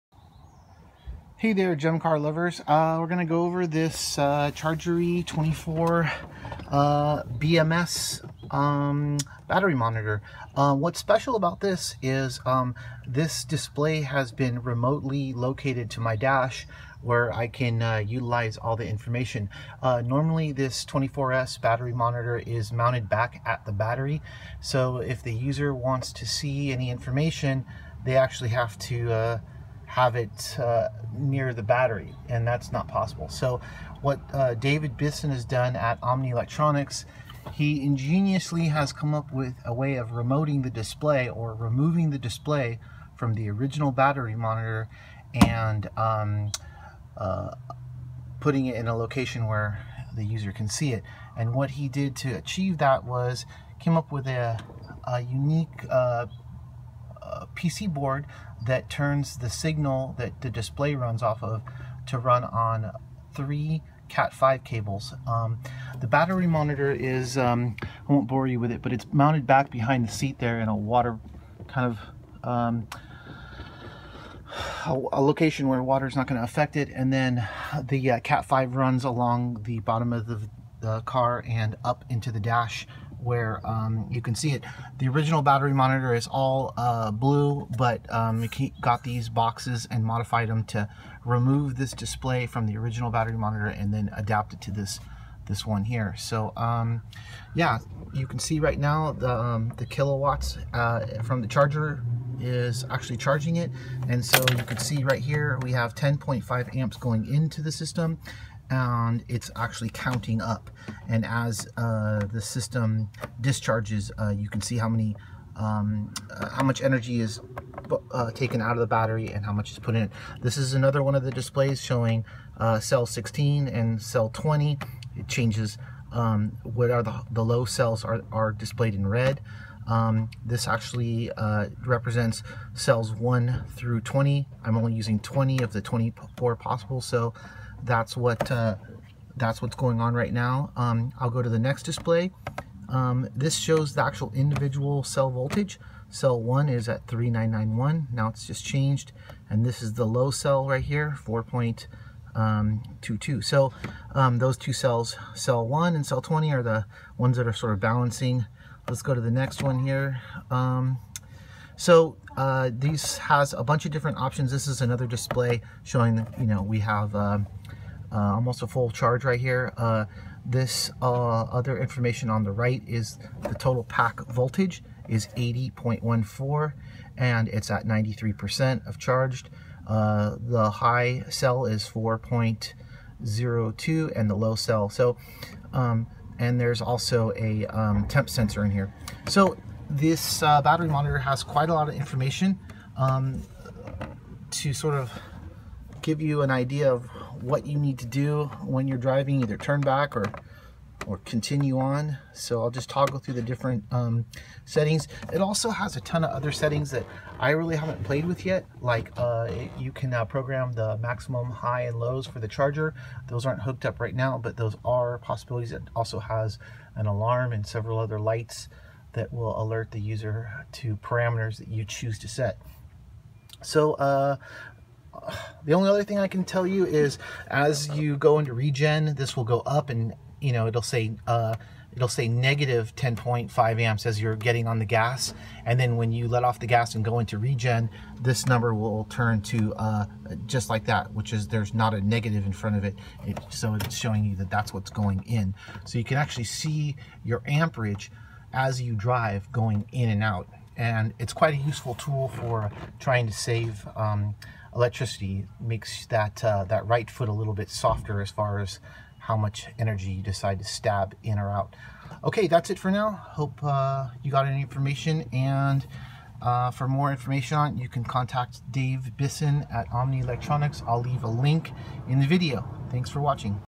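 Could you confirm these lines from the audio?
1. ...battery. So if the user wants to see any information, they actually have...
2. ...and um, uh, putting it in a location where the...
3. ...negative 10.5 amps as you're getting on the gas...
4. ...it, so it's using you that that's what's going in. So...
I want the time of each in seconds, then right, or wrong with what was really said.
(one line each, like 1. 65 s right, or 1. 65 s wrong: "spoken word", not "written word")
1. 23 s right
2. 45 s right
3. 232 s right
4. 243 s wrong: "showing", not "using".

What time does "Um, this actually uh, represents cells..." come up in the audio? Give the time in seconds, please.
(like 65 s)
129 s.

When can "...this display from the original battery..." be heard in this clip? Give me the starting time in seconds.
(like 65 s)
91 s.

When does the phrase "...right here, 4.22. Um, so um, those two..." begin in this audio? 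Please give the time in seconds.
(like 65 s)
150 s.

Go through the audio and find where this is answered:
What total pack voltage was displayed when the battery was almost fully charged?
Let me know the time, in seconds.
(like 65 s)
175 s.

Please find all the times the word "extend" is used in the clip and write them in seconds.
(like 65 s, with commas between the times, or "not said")
not said.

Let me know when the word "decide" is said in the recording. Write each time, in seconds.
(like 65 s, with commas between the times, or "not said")
260 s.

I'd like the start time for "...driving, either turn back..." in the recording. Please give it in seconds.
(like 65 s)
198 s.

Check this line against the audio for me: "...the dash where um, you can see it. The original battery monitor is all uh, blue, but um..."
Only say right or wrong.
right.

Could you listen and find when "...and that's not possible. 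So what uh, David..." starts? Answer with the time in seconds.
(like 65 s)
32 s.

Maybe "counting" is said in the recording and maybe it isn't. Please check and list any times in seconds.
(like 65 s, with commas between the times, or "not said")
109 s.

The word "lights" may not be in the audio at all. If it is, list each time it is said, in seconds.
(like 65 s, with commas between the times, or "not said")
218 s.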